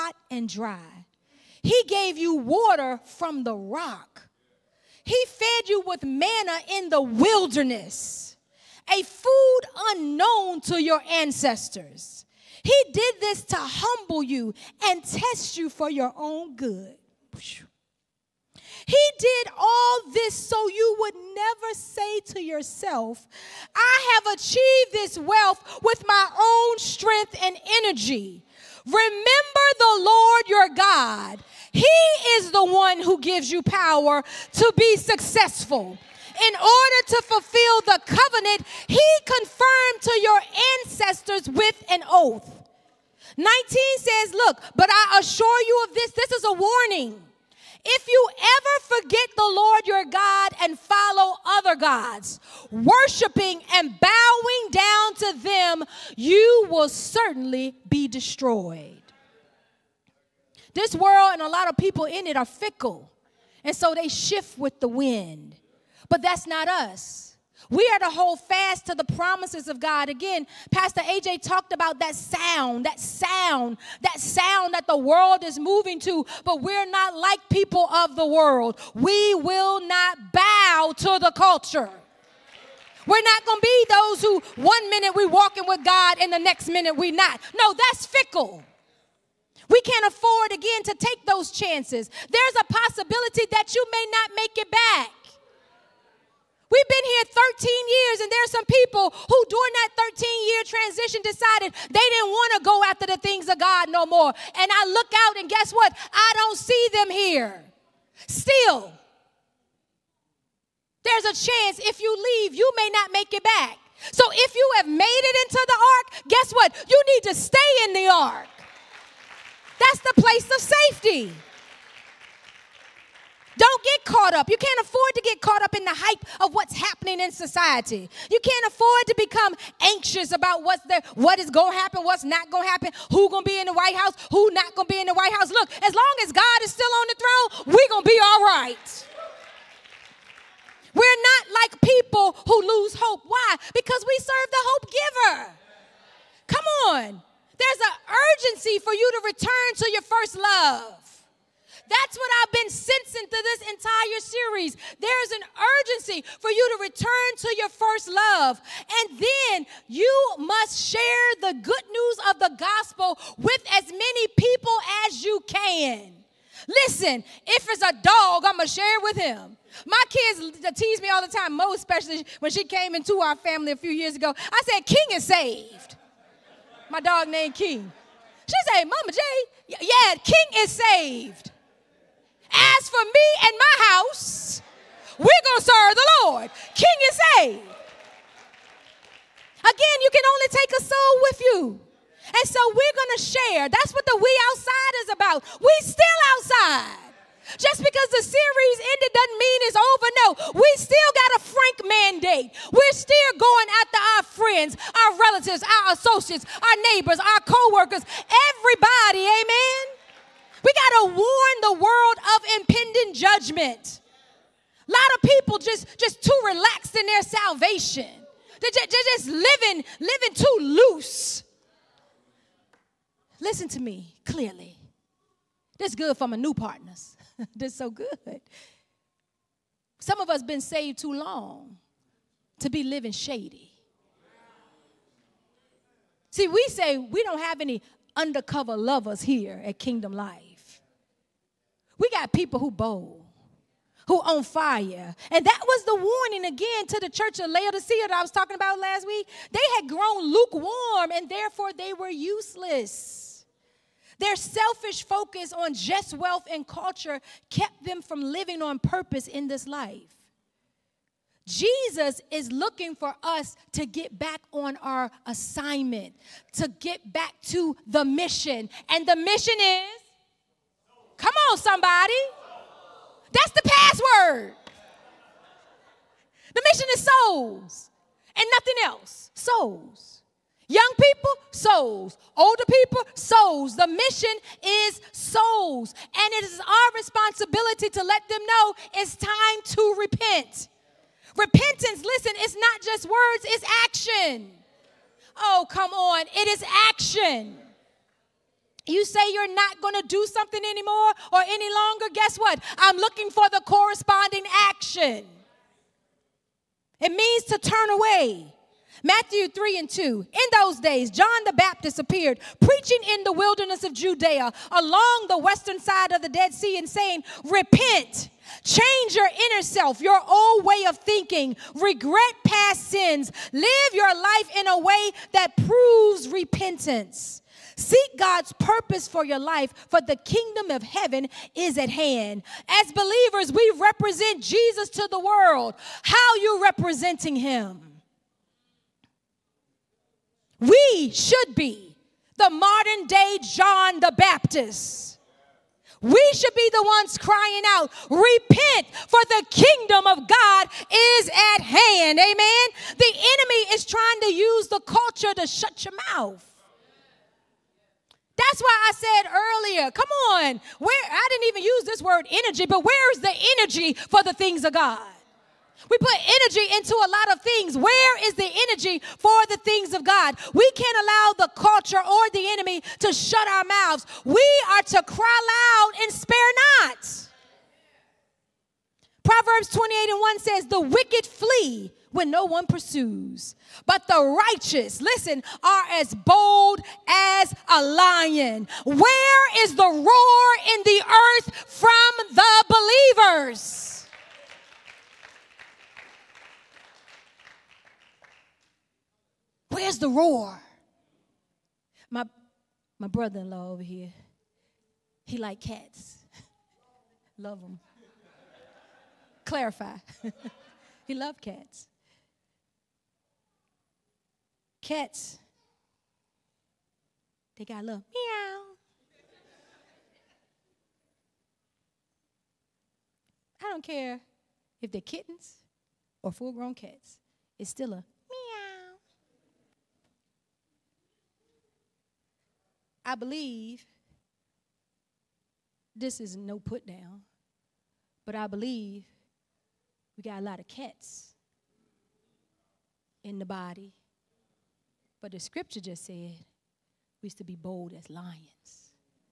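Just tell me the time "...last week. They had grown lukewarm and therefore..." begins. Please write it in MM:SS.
04:08.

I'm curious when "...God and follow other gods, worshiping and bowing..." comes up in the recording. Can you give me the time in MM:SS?
00:50.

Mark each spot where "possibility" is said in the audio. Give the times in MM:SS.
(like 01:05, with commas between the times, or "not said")
01:32.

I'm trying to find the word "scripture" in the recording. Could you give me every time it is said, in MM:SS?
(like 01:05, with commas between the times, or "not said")
07:25.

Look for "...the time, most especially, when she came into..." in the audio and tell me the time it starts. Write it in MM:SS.
02:51.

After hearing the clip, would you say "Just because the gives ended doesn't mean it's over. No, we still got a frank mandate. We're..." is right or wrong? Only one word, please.
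wrong.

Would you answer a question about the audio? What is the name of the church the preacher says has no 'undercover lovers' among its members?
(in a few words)
Kingdom Life.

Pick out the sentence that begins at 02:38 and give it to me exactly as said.
And then you must share the good news of the gospel with as many people as you can.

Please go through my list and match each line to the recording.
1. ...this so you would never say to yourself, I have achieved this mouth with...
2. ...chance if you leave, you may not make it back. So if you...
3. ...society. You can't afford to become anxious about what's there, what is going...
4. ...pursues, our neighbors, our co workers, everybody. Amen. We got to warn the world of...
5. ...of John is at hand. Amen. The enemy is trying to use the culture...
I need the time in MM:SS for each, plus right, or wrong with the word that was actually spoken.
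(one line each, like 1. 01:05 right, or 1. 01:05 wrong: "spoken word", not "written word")
1. 00:20 wrong: "wealth", not "mouth"
2. 01:51 right
3. 02:07 right
4. 03:25 wrong: "associates", not "pursues"
5. 05:50 wrong: "God", not "John".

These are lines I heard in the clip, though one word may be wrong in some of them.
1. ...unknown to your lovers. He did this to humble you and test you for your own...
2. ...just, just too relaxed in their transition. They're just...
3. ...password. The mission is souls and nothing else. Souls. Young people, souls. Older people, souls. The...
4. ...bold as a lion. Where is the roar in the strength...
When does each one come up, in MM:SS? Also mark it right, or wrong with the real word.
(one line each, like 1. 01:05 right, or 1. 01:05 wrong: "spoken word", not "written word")
1. 00:09 wrong: "ancestors", not "lovers"
2. 03:35 wrong: "salvation", not "transition"
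3. 04:33 right
4. 06:26 wrong: "earth", not "strength".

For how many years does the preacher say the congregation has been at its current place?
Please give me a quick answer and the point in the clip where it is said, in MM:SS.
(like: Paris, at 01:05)
13, at 01:37.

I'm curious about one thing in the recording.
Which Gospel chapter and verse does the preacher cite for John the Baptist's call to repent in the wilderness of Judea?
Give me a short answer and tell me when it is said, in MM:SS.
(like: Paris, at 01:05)
Matthew 3:2, at 05:09.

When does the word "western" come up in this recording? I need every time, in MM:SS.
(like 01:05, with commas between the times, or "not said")
05:15.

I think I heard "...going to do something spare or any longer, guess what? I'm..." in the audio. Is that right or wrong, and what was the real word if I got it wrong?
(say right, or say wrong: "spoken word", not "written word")
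wrong: "anymore", not "spare".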